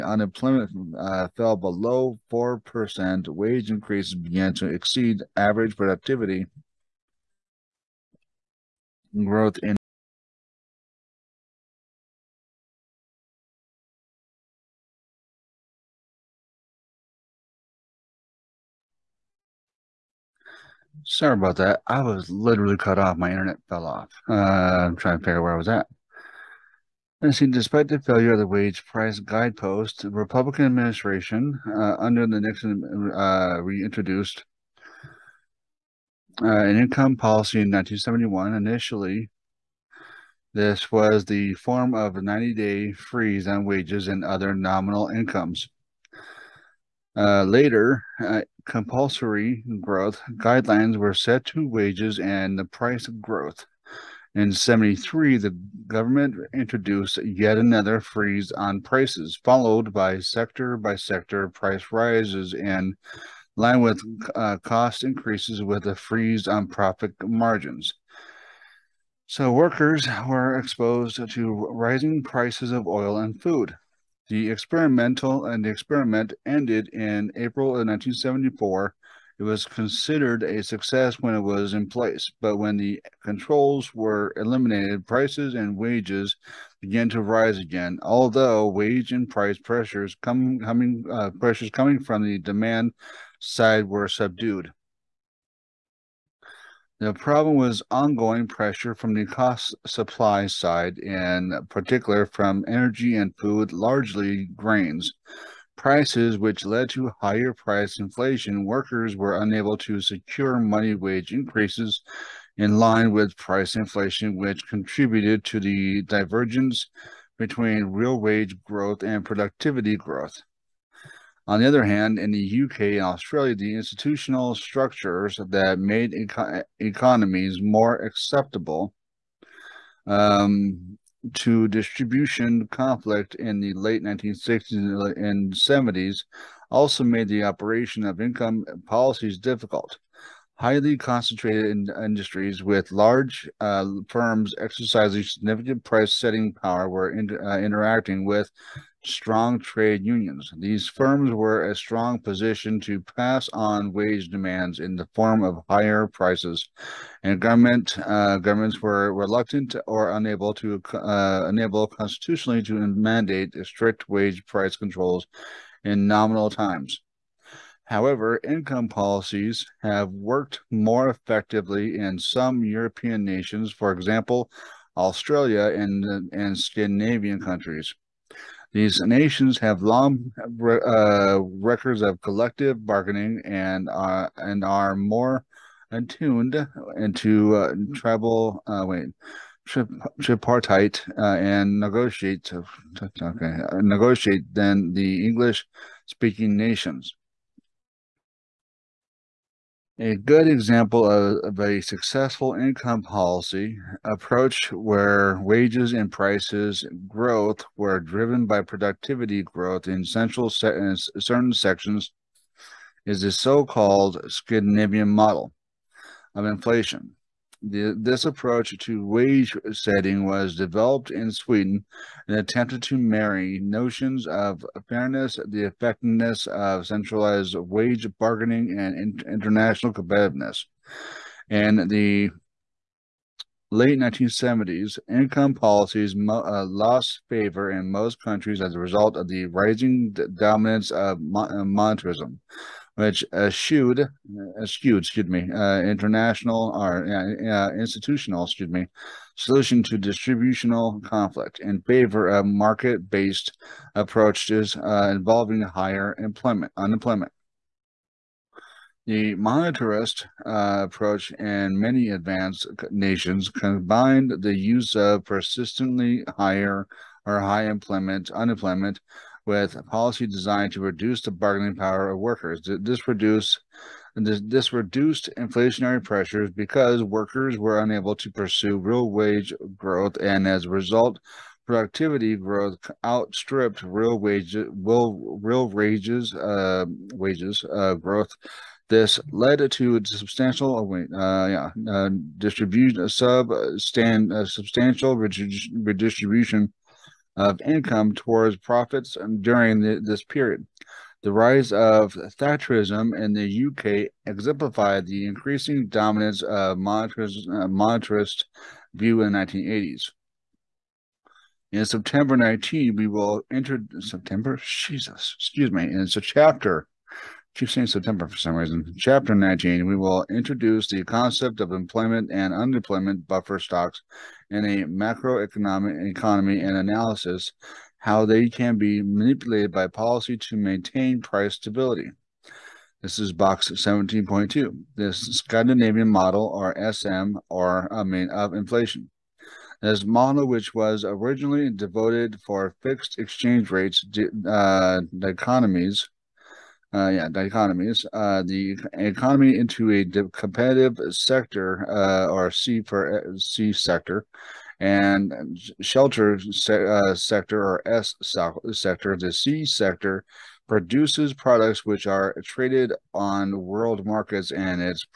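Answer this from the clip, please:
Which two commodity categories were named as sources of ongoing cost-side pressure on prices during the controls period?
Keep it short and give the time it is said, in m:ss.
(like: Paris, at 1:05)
Energy and food, at 1:42.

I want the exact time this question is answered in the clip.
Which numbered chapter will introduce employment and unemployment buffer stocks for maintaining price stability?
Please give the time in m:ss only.
5:18.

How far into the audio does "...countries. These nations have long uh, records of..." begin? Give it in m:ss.
2:57.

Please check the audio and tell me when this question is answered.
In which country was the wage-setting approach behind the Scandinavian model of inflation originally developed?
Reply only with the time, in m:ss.
3:41.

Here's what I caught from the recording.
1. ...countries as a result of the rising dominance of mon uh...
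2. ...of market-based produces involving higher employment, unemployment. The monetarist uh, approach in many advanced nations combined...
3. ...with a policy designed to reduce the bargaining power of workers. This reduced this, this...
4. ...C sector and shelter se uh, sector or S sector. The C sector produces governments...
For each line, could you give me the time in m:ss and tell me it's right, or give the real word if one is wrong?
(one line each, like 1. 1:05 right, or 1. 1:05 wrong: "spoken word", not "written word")
1. 3:58 right
2. 4:12 wrong: "approaches", not "produces"
3. 4:29 right
4. 5:53 wrong: "products", not "governments".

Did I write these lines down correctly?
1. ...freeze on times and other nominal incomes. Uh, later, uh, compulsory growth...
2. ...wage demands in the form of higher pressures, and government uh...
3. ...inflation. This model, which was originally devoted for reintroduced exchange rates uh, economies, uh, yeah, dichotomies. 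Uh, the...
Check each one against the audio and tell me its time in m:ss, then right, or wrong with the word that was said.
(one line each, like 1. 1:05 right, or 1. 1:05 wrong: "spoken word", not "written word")
1. 0:42 wrong: "wages", not "times"
2. 2:33 wrong: "prices", not "pressures"
3. 5:38 wrong: "fixed", not "reintroduced".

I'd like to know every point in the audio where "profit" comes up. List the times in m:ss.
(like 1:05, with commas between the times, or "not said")
1:06, 4:58.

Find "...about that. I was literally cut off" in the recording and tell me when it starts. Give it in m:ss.
0:21.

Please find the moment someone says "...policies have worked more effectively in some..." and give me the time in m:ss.
2:48.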